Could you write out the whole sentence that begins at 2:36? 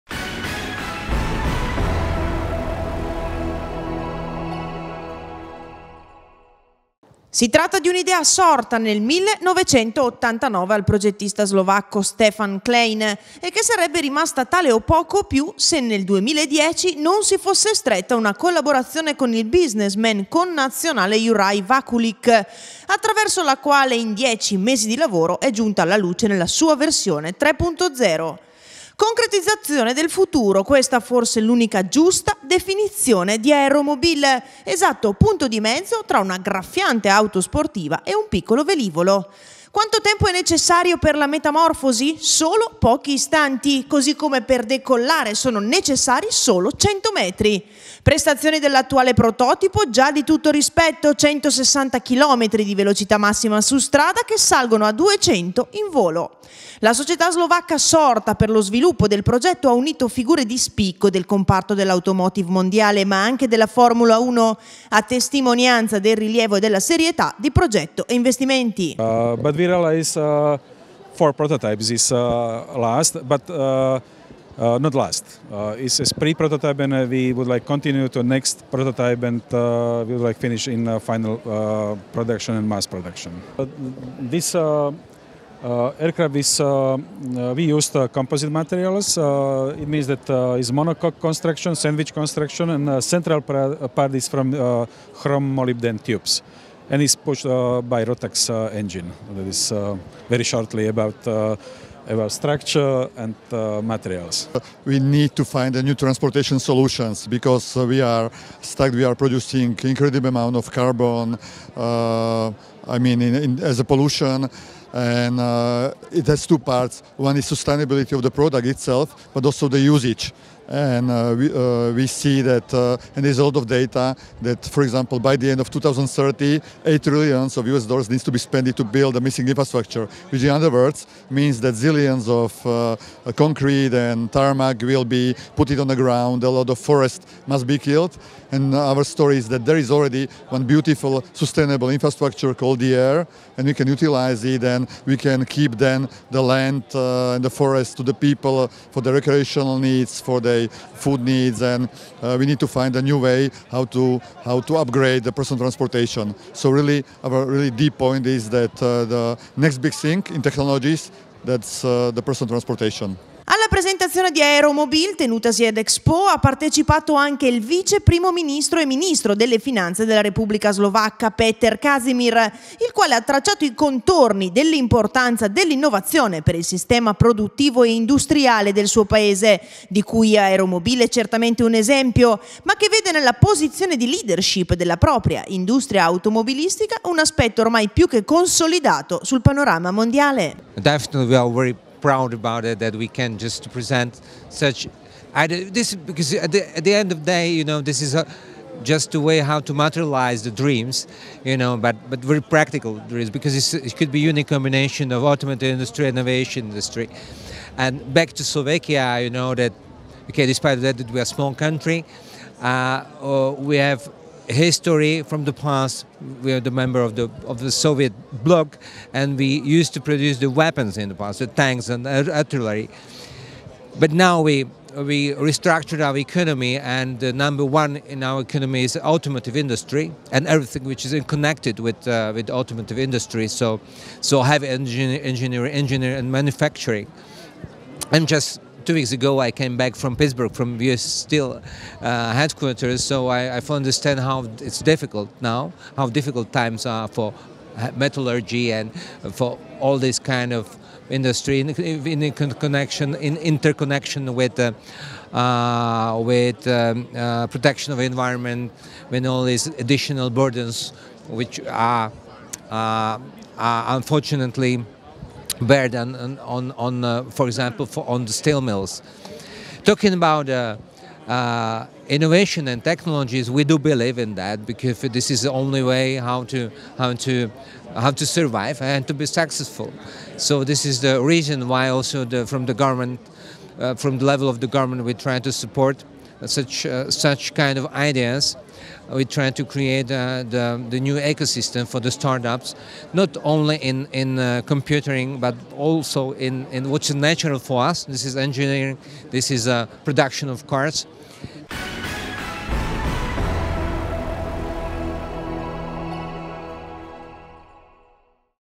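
So really, our really deep point is that uh, the next big thing in technologies that's uh, the personal transportation.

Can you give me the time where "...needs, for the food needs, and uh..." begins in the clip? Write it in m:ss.
2:29.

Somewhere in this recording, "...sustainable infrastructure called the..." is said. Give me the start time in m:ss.
2:21.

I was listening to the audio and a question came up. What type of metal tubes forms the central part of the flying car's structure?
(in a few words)
Chrome molybdenum.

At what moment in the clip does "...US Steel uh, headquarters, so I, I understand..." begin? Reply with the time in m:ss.
4:00.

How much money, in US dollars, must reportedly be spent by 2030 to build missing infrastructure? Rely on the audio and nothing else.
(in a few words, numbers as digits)
8 trillion.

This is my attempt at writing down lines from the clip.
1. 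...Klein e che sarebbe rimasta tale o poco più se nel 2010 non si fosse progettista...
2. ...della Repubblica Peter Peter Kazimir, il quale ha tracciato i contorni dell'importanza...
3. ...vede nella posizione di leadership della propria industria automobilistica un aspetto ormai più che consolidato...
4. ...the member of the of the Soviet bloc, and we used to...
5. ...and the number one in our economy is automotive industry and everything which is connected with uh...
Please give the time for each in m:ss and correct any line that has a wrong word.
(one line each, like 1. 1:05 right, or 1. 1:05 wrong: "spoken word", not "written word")
1. 0:12 wrong: "stretta", not "progettista"
2. 2:50 wrong: "Slovacca", not "Peter"
3. 3:02 right
4. 3:36 right
5. 3:46 right.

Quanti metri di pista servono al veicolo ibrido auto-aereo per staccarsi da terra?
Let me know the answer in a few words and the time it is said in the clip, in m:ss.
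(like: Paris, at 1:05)
100 metri, at 0:46.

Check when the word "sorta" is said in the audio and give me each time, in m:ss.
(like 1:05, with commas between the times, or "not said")
0:08, 0:57.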